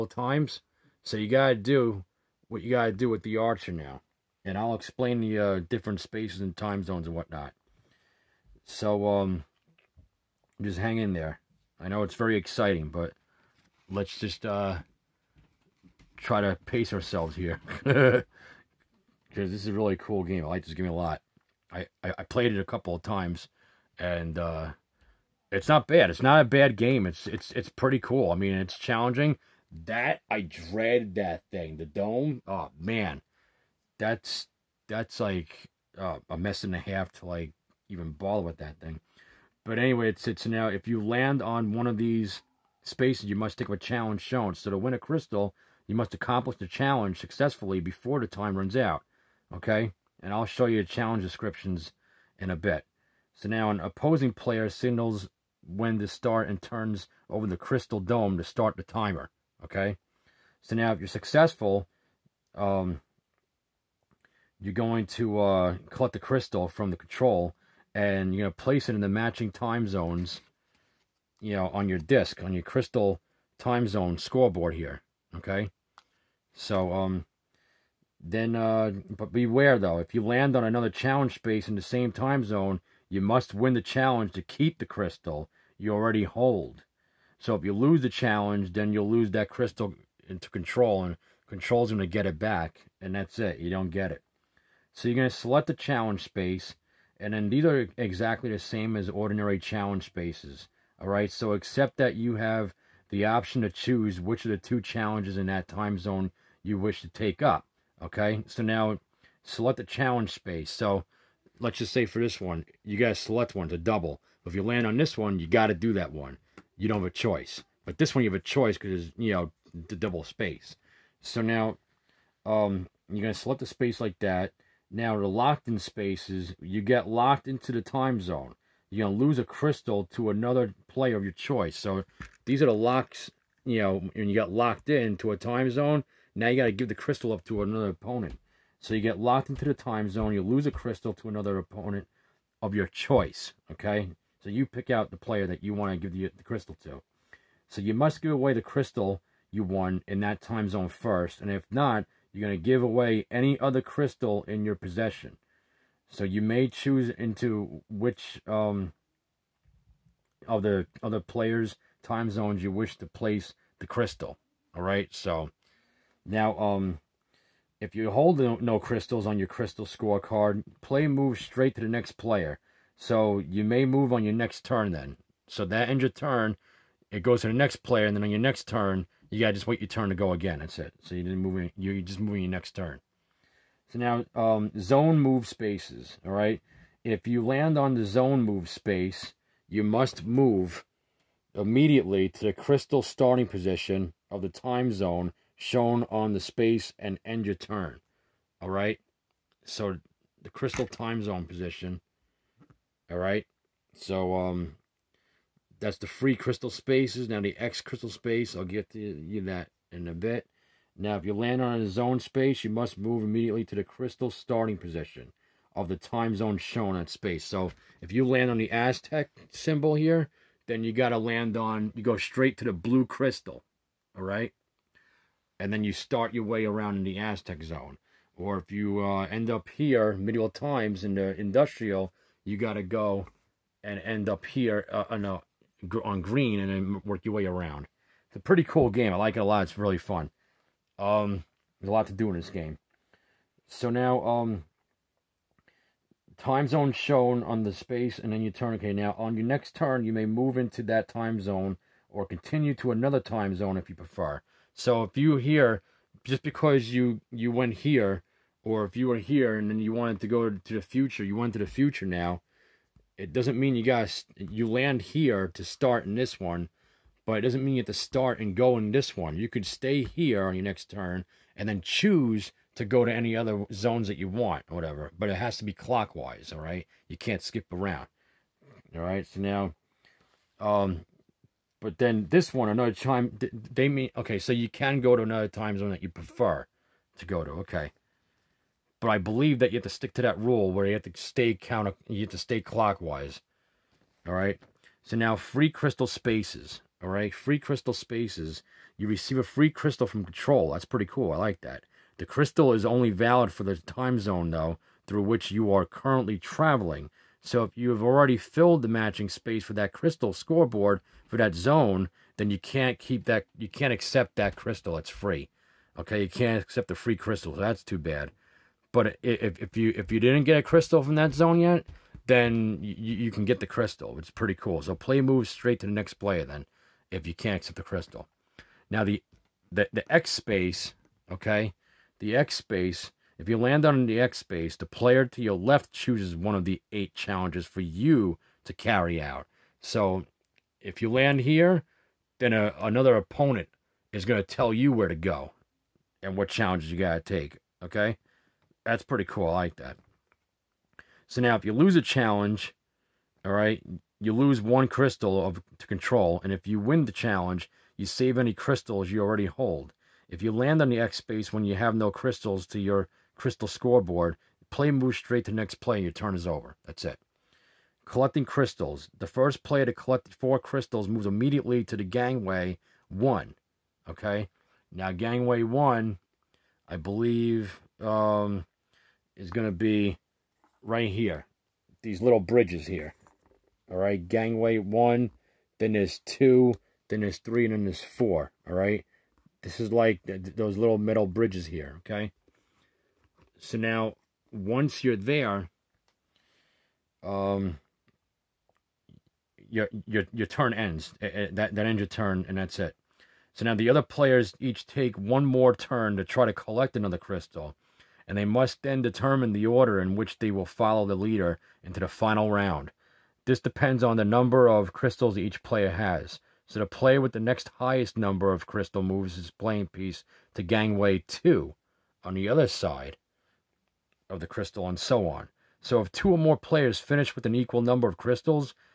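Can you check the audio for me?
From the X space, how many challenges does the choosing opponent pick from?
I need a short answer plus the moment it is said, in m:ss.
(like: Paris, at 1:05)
8, at 5:36.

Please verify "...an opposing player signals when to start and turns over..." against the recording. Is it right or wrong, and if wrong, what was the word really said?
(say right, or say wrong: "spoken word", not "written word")
right.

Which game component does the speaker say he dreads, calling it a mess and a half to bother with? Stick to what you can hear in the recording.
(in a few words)
The dome.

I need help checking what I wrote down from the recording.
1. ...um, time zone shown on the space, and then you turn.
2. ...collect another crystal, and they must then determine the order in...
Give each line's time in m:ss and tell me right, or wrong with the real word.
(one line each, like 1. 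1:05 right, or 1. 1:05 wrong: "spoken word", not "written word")
1. 4:04 right
2. 6:46 right.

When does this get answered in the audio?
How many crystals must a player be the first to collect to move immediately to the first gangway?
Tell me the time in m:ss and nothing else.
6:10.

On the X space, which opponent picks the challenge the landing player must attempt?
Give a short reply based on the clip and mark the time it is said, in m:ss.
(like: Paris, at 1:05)
The player to your left, at 5:34.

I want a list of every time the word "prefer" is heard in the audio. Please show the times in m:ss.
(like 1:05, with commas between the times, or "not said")
4:13, 4:46.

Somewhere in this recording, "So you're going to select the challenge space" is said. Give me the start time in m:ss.
1:34.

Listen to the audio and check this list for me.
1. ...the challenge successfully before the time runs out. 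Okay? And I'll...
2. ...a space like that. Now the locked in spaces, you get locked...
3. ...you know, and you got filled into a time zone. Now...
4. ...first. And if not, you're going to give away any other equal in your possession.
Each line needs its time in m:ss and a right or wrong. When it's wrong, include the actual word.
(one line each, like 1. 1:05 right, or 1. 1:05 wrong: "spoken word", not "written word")
1. 0:46 right
2. 2:03 right
3. 2:13 wrong: "locked", not "filled"
4. 2:30 wrong: "crystal", not "equal".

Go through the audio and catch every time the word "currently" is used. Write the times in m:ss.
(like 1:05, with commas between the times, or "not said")
5:05.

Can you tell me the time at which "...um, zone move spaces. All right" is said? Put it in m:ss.
3:04.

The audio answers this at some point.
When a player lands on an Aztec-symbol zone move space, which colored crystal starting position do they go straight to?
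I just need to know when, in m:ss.
3:42.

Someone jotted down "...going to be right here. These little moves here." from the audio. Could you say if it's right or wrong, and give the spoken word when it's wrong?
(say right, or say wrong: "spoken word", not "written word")
wrong: "bridges", not "moves".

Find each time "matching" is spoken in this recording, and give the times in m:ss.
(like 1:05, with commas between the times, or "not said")
1:09, 5:08.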